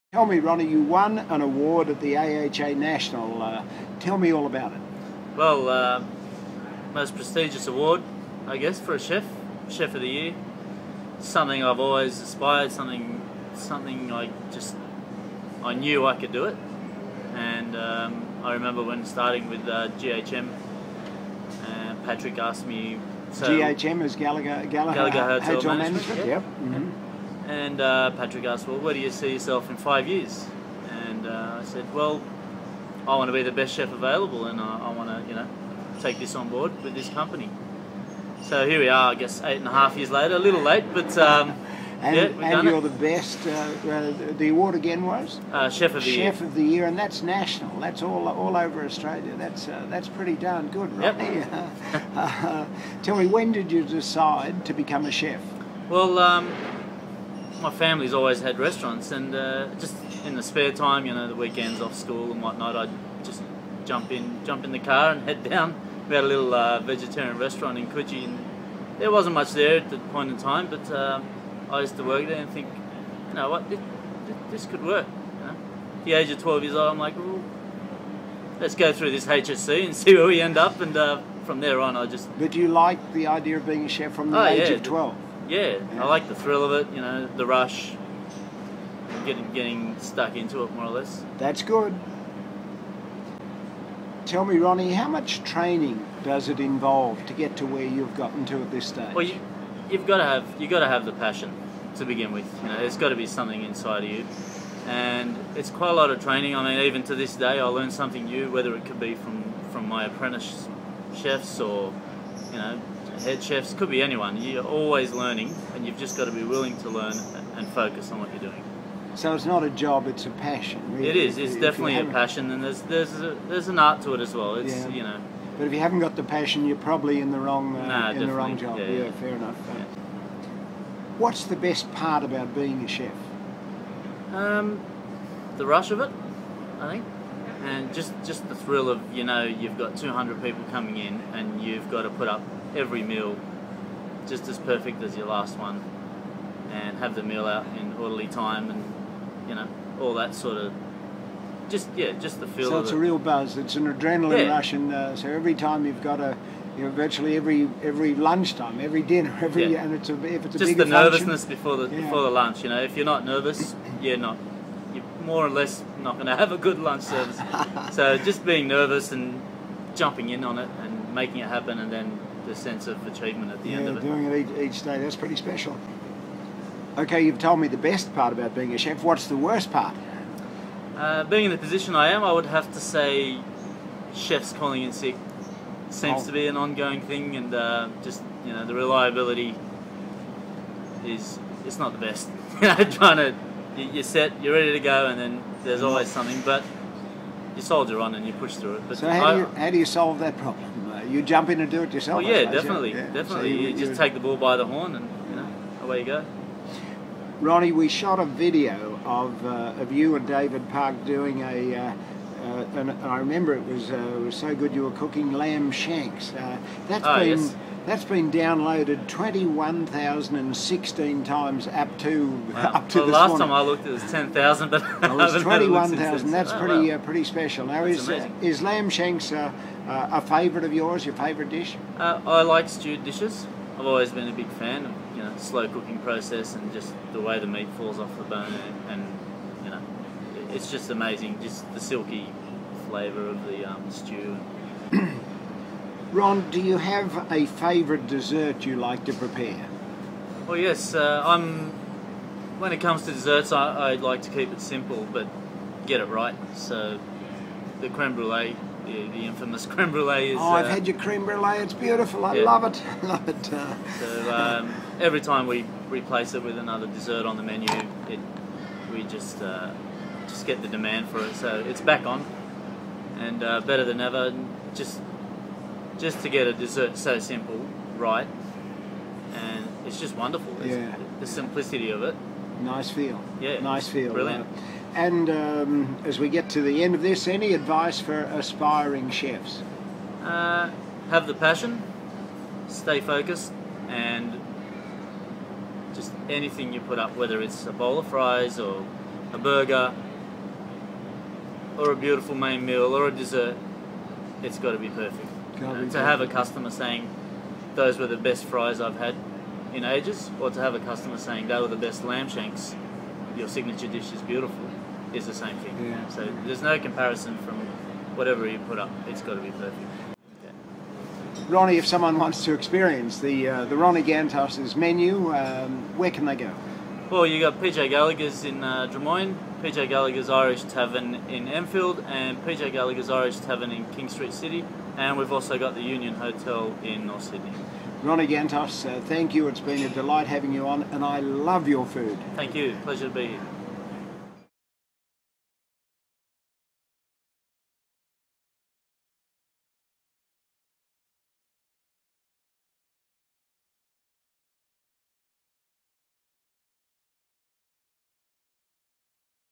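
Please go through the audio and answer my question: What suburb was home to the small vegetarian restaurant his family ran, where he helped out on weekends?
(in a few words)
Coogee.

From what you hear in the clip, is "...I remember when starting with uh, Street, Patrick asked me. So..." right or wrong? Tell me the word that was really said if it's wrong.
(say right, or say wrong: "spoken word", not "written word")
wrong: "GHM", not "Street".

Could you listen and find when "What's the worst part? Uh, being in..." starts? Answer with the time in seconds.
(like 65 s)
179 s.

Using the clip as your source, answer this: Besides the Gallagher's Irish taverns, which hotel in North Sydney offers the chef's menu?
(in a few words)
Union Hotel.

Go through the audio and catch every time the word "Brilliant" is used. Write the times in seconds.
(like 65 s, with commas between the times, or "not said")
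284 s.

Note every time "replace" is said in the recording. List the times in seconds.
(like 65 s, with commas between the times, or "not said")
265 s.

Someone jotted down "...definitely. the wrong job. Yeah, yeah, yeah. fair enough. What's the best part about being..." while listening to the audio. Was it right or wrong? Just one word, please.
right.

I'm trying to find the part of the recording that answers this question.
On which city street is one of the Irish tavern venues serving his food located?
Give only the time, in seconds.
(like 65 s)
333 s.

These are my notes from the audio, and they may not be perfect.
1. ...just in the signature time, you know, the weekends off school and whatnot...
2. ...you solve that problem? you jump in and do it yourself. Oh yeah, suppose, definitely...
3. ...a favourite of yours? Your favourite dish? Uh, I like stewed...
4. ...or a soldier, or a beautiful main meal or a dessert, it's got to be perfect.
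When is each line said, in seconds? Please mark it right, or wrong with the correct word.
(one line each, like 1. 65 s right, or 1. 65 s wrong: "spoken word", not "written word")
1. 59 s wrong: "spare", not "signature"
2. 199 s right
3. 229 s right
4. 298 s wrong: "burger", not "soldier".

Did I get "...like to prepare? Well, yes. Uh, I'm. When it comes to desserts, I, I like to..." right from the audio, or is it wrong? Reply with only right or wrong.
right.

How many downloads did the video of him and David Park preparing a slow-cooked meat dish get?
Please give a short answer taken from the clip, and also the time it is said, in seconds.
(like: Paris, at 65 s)
21,016, at 219 s.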